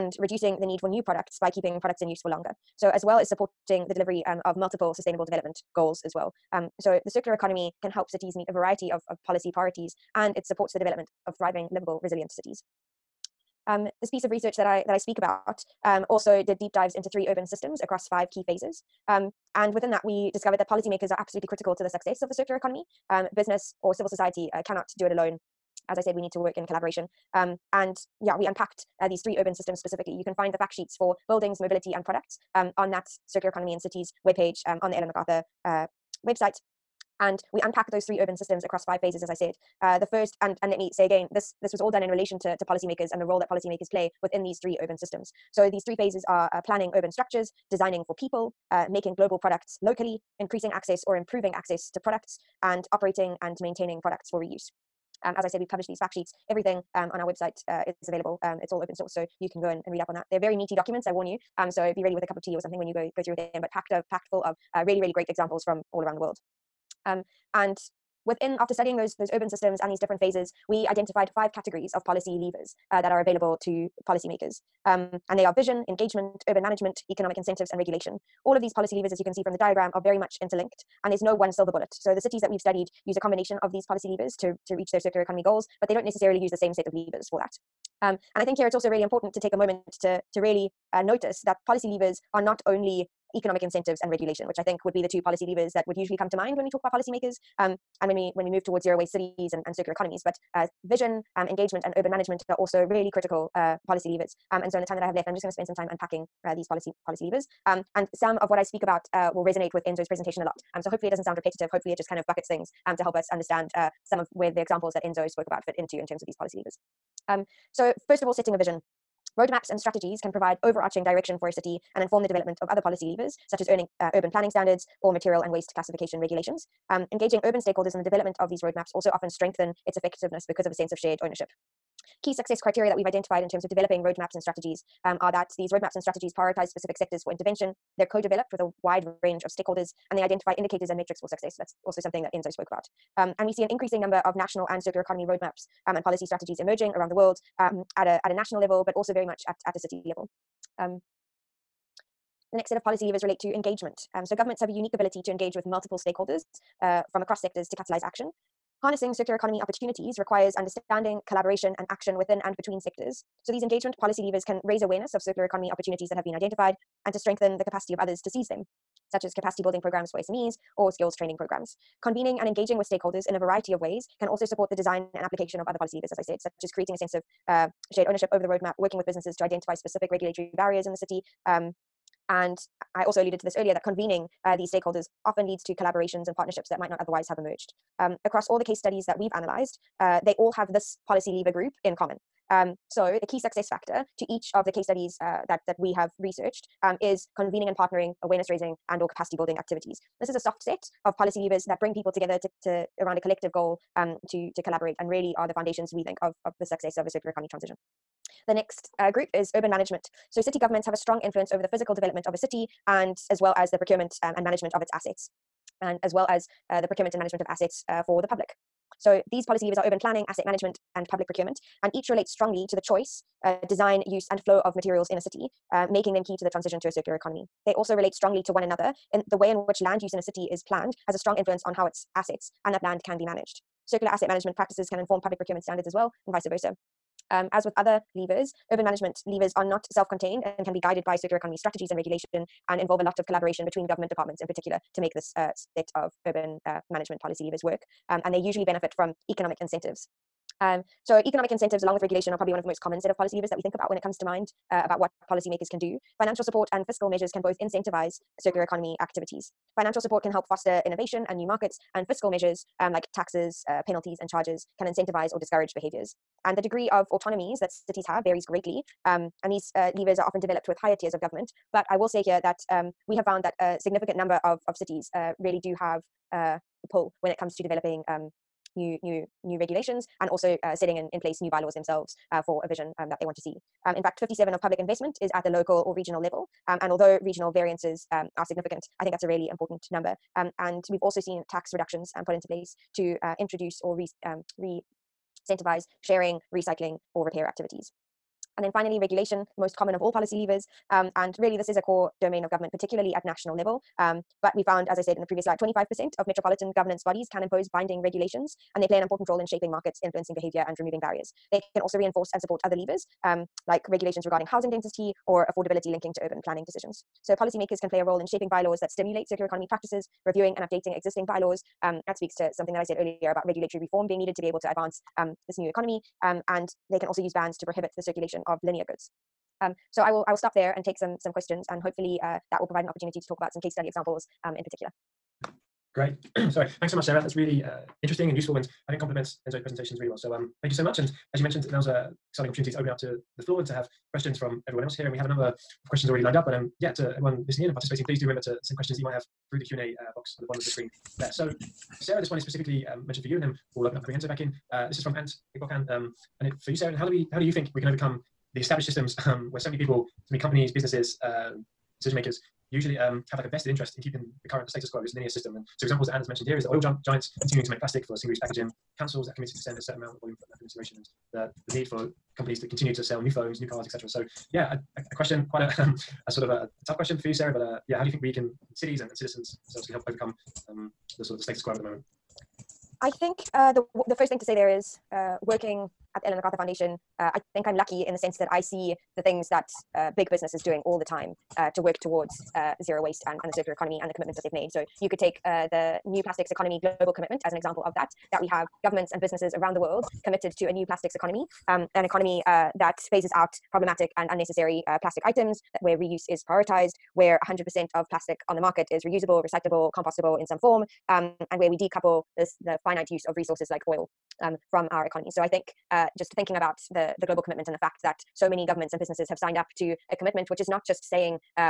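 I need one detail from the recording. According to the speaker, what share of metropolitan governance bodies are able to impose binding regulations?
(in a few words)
25%.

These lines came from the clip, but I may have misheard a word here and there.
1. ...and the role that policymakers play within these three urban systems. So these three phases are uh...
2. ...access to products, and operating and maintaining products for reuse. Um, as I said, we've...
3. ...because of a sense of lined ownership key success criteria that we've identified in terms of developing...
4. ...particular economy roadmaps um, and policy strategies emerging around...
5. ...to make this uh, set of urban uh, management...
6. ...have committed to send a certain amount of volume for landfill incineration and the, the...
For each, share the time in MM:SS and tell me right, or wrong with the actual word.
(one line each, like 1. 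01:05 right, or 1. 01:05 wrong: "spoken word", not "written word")
1. 00:43 right
2. 00:51 right
3. 02:10 wrong: "shared", not "lined"
4. 02:24 wrong: "circular", not "particular"
5. 04:04 right
6. 06:09 right.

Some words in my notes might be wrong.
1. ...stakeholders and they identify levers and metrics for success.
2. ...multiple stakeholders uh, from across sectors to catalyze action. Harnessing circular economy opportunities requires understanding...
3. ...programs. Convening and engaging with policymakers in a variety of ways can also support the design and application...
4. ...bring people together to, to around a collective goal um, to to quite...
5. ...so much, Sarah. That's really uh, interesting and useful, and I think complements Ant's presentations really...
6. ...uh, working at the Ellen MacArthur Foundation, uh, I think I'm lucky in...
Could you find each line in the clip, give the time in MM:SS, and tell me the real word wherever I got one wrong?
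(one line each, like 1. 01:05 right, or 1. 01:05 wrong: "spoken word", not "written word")
1. 02:19 wrong: "indicators", not "levers"
2. 02:35 right
3. 02:51 wrong: "stakeholders", not "policymakers"
4. 03:21 wrong: "collaborate", not "quite"
5. 05:36 wrong: "Enzo", not "Ant"
6. 06:25 right.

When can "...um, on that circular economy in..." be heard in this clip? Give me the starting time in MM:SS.
00:32.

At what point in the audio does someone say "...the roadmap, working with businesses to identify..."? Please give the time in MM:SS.
02:58.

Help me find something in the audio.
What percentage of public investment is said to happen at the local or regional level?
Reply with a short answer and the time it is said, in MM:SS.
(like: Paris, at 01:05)
57%, at 04:44.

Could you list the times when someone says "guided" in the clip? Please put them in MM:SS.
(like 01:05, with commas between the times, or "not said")
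04:00.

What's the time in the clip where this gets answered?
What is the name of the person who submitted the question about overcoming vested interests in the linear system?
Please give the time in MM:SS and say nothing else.
05:55.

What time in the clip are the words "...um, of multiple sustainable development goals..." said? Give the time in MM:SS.
00:04.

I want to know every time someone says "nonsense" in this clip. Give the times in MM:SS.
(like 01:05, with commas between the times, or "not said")
not said.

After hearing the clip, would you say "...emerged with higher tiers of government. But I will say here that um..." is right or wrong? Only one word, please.
wrong.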